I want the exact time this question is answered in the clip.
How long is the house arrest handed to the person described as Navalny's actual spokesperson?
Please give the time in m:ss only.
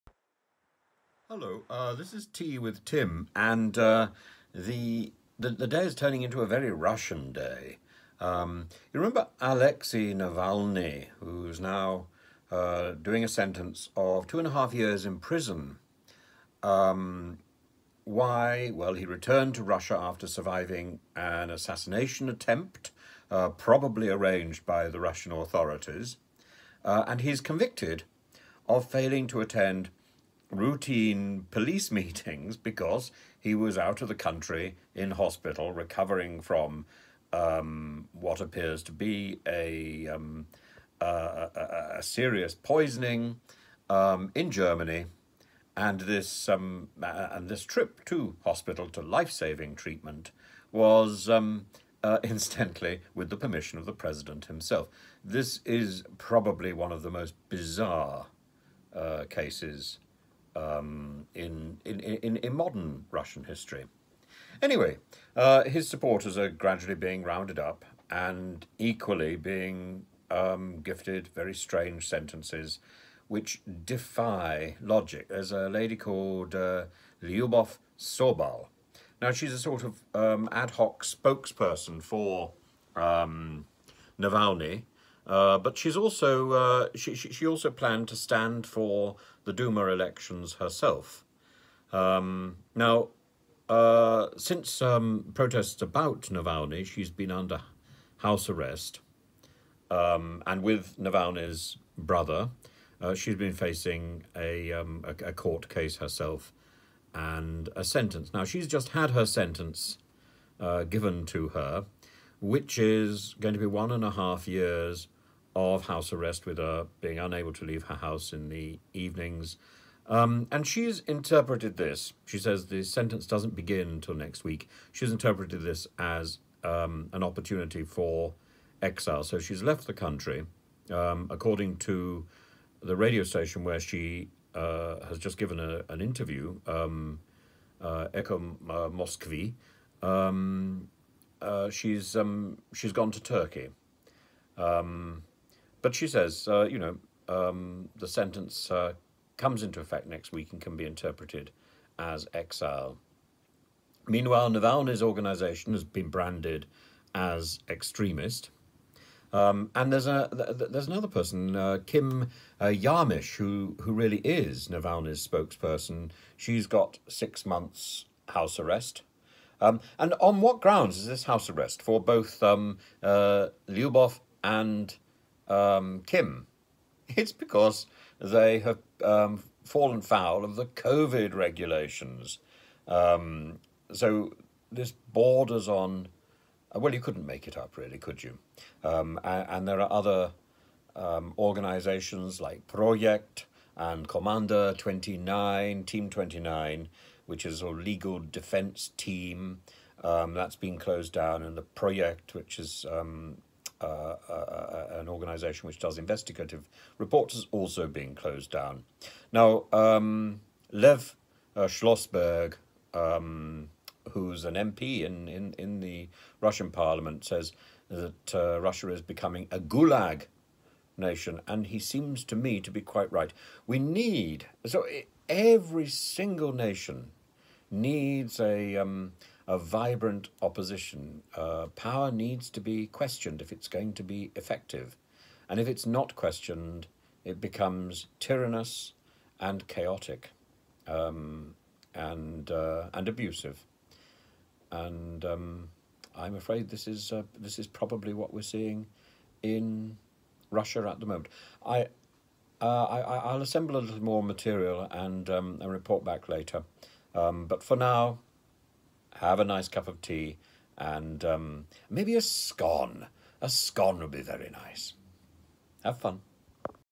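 2:47.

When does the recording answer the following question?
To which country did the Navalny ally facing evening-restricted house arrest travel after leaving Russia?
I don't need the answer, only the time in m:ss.
2:23.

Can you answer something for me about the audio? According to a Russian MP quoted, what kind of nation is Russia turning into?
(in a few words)
gulag nation.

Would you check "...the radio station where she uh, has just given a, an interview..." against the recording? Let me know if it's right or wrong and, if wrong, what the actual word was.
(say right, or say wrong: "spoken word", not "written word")
right.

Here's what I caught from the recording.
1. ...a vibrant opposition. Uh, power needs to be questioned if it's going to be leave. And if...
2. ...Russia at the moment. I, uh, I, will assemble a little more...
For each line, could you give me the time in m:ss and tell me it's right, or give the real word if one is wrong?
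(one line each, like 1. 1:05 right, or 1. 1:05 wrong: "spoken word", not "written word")
1. 3:49 wrong: "effective", not "leave"
2. 4:10 right.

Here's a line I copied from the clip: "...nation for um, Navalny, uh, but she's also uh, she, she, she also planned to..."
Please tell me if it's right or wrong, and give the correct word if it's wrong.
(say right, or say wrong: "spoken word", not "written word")
wrong: "spokesperson", not "nation".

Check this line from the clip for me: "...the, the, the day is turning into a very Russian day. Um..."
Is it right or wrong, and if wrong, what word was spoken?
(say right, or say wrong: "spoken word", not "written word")
right.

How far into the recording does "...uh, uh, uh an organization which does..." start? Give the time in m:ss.
3:23.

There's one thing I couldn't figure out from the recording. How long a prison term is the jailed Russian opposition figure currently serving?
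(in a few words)
2.5 years.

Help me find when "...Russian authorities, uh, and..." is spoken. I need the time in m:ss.
0:24.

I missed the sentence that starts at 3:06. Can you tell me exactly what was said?
Uh, well, you couldn't make it up, really, could you?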